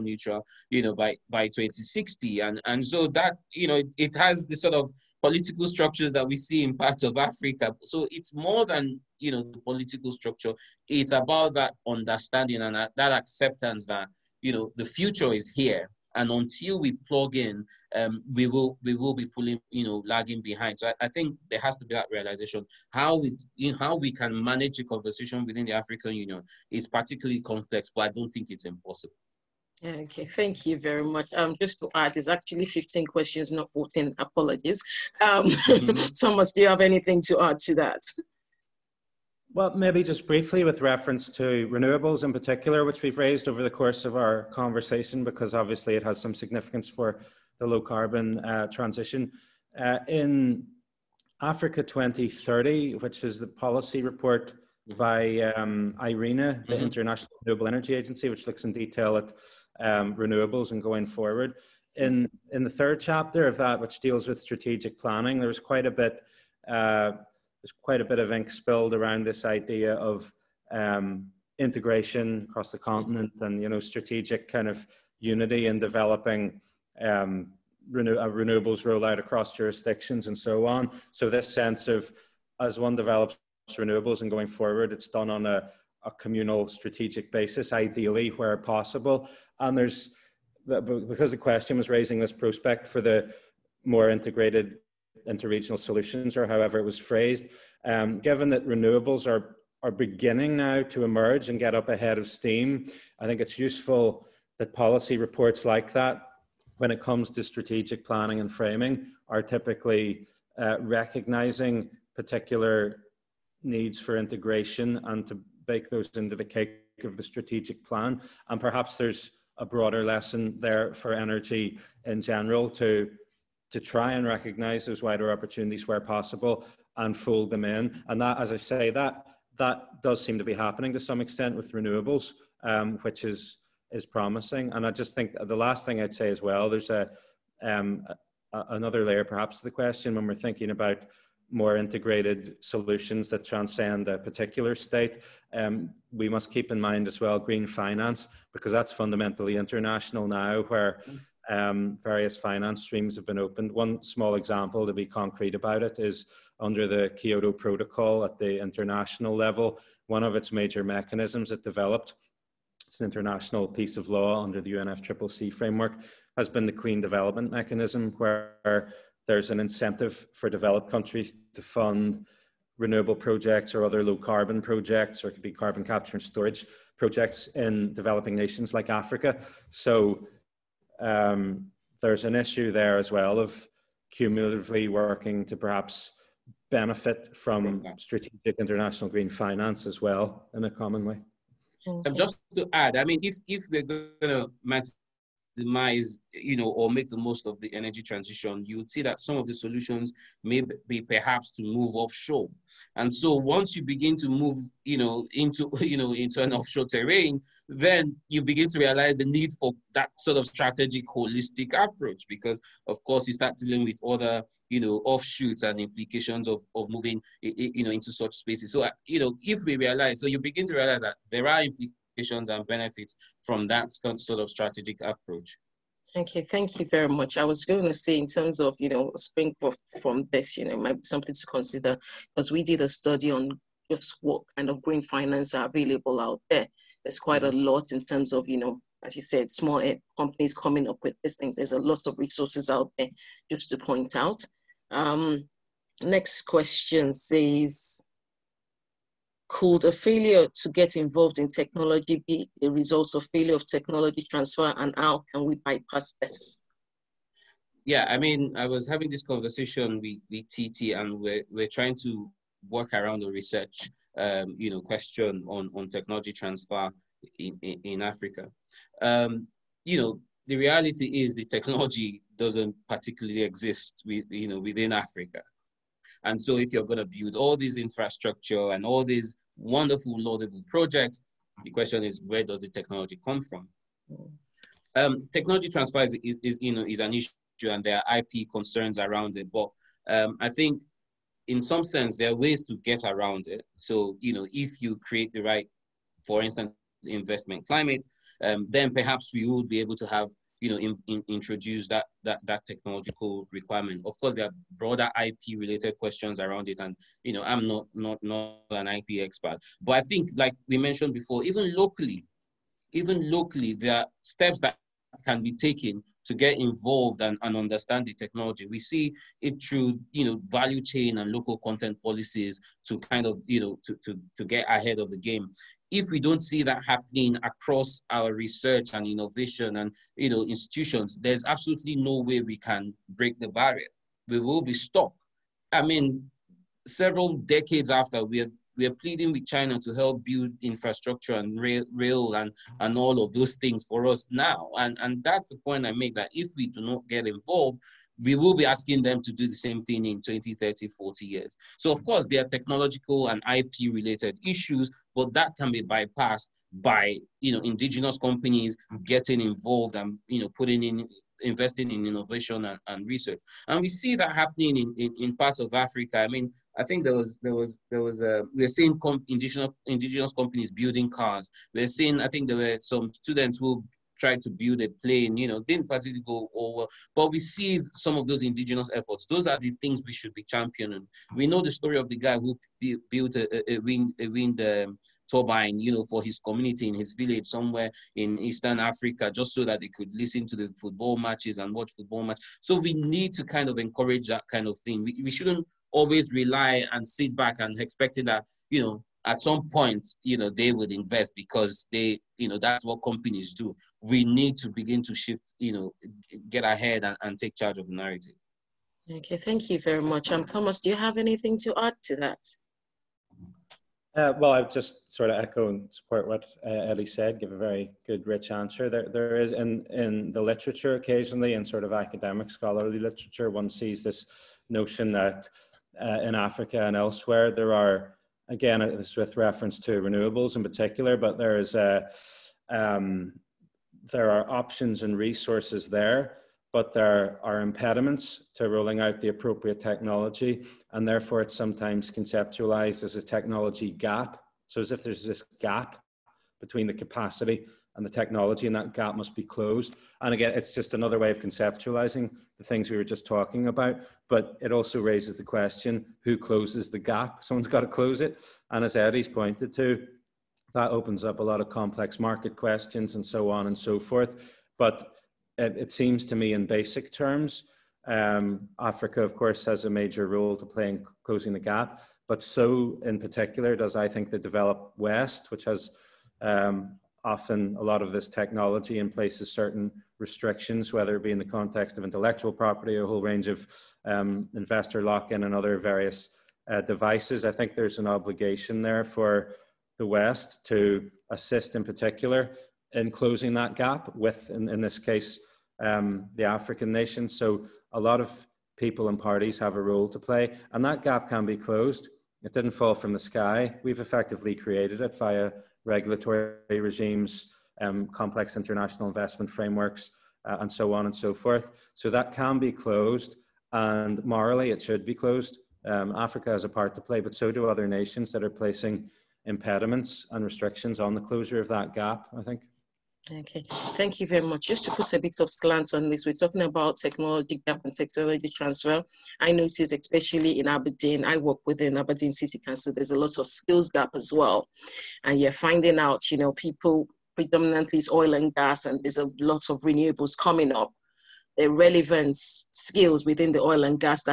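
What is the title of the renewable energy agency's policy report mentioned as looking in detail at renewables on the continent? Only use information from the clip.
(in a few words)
Africa 2030.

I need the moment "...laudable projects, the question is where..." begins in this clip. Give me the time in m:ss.
4:40.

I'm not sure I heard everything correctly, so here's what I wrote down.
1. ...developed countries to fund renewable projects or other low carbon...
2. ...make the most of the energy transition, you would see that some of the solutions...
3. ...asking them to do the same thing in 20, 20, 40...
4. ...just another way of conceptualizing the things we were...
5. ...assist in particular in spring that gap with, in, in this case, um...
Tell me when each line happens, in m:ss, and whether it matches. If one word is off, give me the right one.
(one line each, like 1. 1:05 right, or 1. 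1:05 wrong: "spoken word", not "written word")
1. 2:50 right
2. 3:16 right
3. 5:48 wrong: "30", not "20"
4. 7:30 right
5. 8:11 wrong: "closing", not "spring".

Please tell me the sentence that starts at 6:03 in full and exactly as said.
And we see that happening in, in, in, parts of Africa.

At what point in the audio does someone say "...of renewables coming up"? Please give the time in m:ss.
8:59.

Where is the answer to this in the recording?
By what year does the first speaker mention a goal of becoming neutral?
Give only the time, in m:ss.
0:01.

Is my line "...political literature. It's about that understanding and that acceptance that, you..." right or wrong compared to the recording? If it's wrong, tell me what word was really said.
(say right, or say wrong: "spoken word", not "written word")
wrong: "structure", not "literature".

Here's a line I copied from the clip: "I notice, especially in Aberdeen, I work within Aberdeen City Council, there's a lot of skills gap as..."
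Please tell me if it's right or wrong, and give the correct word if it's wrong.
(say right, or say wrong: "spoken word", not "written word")
right.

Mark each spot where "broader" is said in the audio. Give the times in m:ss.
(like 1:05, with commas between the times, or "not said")
1:59, 5:04.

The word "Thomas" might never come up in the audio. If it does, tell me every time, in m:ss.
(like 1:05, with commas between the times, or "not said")
0:36, 6:50.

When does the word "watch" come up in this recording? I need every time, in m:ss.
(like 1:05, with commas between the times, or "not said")
6:31.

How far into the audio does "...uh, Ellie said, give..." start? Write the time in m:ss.
6:56.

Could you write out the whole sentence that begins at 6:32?
So we need to kind of encourage that kind of thing.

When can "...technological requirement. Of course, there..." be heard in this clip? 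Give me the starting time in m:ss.
5:02.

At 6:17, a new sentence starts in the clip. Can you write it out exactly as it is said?
But we see some of those indigenous efforts.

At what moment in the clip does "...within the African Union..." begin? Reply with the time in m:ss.
0:25.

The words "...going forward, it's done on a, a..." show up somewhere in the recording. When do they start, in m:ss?
1:24.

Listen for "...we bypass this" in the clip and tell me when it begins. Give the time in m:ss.
4:15.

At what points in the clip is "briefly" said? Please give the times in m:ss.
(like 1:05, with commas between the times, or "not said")
0:40.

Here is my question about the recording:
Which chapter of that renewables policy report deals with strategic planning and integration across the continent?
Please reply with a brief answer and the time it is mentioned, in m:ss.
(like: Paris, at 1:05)
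Third chapter, at 1:02.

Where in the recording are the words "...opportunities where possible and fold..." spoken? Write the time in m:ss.
2:05.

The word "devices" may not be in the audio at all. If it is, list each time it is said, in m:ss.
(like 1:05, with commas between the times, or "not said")
8:06.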